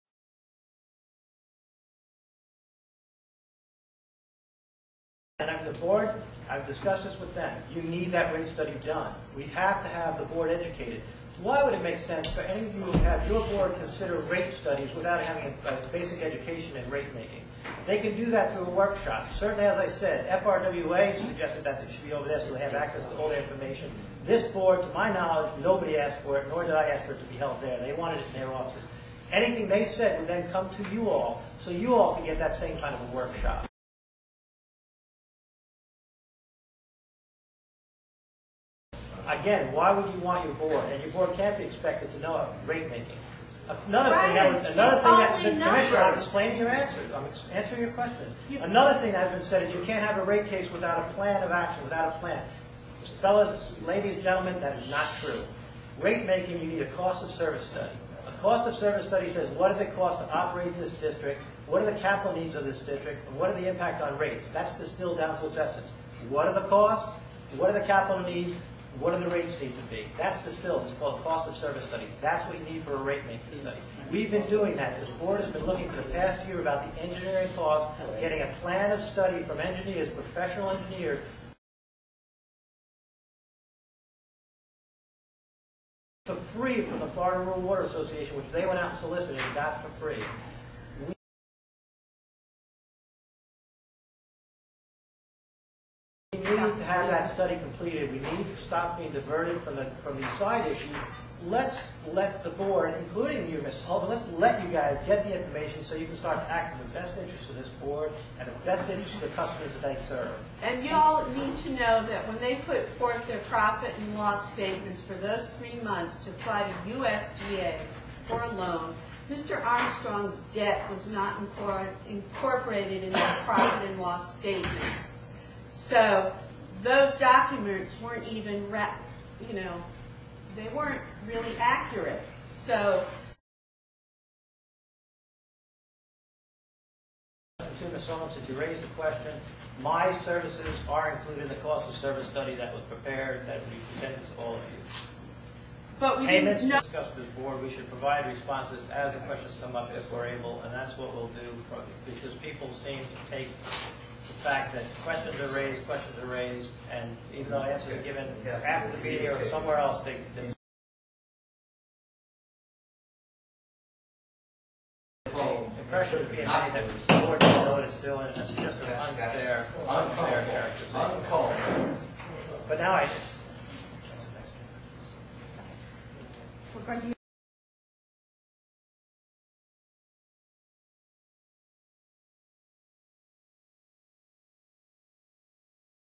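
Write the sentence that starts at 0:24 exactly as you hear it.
This board, to my knowledge, nobody asked for it, nor did I ask for it to be held there.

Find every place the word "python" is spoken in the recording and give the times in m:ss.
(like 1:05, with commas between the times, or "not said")
not said.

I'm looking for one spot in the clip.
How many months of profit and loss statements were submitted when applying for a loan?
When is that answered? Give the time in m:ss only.
1:55.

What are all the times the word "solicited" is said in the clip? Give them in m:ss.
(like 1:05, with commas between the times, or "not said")
1:28.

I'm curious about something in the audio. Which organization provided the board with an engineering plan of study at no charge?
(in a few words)
Florida Rural Water Association.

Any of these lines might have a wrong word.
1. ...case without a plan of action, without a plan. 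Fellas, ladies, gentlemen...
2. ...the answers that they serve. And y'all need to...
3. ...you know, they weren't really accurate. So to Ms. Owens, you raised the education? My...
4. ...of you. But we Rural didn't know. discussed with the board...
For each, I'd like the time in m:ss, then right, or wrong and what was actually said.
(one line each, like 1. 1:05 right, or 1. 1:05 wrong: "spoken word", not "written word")
1. 0:50 right
2. 1:49 wrong: "customers", not "answers"
3. 2:09 wrong: "question", not "education"
4. 2:24 wrong: "Payments", not "Rural".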